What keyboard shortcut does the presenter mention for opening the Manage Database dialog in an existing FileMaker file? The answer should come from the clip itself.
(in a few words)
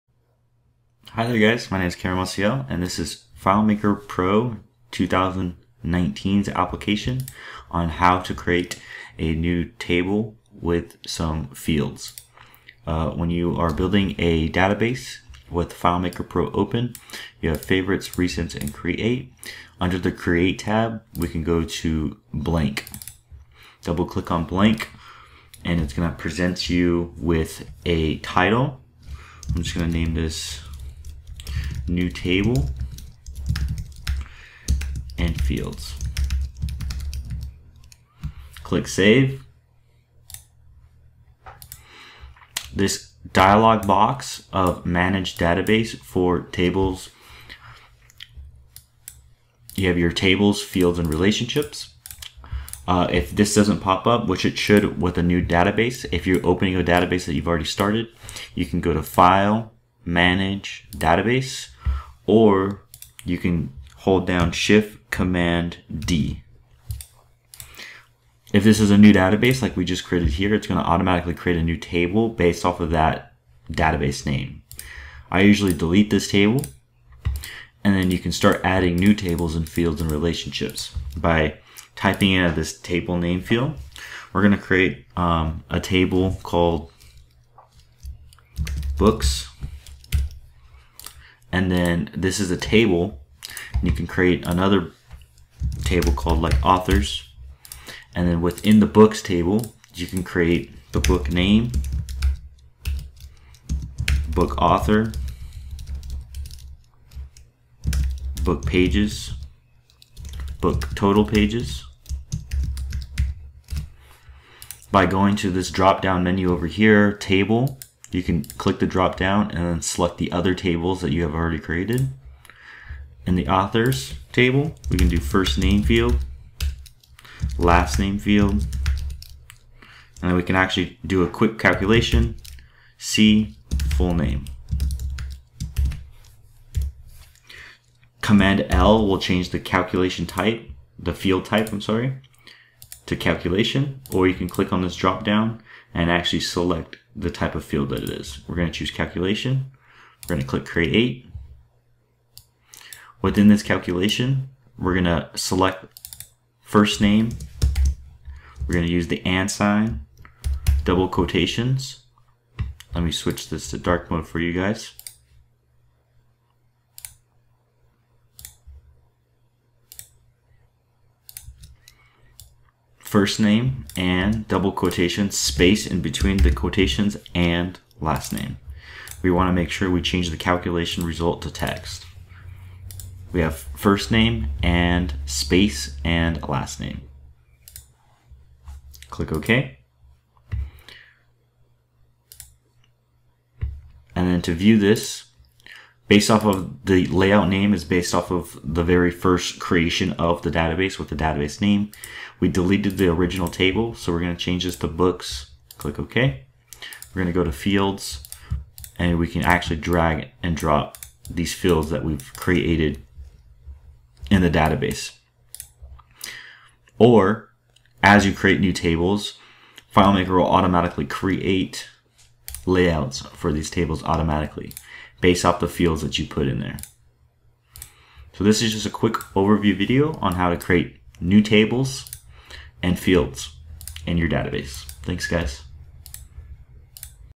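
Shift Command D.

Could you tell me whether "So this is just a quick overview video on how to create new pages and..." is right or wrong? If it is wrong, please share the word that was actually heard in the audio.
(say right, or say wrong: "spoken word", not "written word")
wrong: "tables", not "pages".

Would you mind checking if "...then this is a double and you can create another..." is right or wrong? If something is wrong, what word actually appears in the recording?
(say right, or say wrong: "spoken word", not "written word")
wrong: "table", not "double".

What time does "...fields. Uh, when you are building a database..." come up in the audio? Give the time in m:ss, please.
0:11.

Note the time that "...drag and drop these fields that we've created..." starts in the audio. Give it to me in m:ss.
3:29.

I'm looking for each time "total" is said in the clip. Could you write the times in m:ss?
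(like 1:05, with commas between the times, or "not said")
1:50.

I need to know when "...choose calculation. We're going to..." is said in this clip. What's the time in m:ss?
2:28.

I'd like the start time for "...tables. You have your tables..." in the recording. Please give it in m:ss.
0:46.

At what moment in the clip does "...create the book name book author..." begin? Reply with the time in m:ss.
1:40.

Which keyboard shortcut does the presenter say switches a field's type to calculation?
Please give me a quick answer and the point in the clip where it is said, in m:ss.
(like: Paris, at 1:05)
Command L, at 2:18.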